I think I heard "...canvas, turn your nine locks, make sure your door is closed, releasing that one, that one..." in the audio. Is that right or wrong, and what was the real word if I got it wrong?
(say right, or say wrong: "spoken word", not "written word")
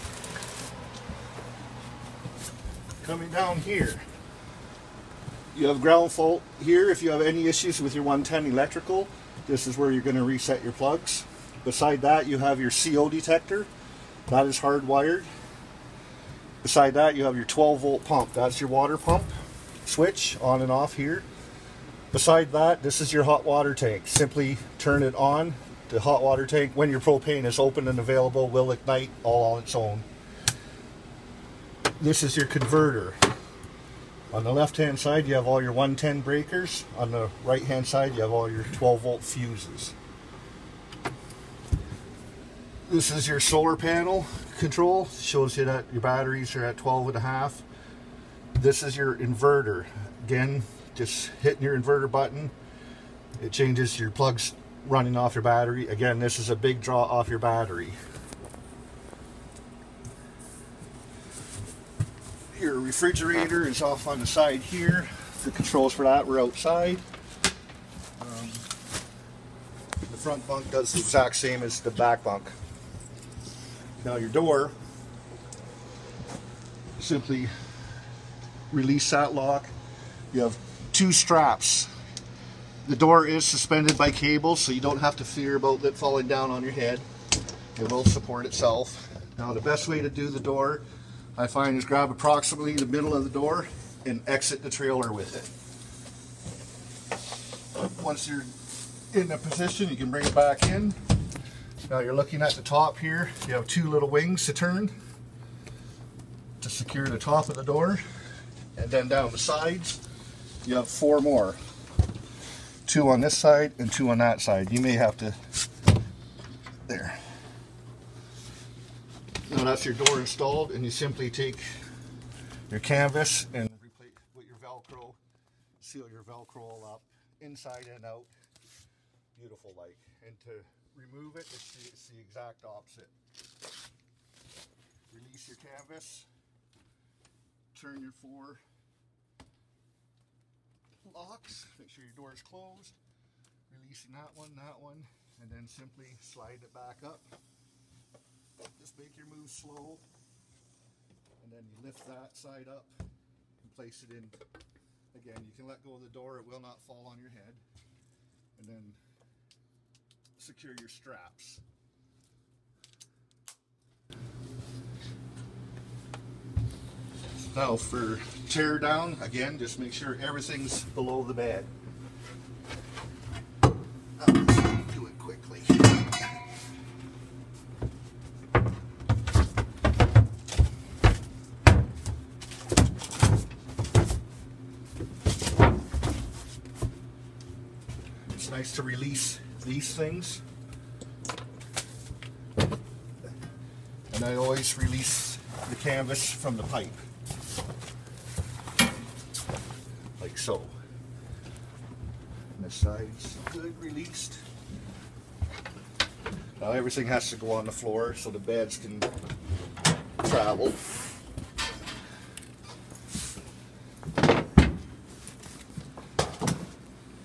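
wrong: "four", not "nine".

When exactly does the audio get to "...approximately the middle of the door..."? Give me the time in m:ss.
1:32.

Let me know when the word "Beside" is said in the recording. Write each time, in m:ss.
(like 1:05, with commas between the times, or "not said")
0:11, 0:16, 0:22.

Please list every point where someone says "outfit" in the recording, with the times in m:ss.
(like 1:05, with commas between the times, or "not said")
not said.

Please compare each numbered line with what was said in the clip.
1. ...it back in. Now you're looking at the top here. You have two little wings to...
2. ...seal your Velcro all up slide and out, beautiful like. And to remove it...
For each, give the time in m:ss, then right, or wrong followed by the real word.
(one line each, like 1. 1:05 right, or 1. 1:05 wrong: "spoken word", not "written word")
1. 1:40 right
2. 2:05 wrong: "inside", not "slide".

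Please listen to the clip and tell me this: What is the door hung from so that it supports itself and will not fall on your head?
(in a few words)
cables.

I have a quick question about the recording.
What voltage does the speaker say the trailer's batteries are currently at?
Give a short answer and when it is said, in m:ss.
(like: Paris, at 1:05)
12.5, at 0:46.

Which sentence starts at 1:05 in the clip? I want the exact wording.
The controls for that were outside.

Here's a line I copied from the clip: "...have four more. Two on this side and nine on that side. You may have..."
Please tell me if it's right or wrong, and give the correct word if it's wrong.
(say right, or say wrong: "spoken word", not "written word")
wrong: "two", not "nine".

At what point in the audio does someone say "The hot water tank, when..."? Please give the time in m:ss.
0:25.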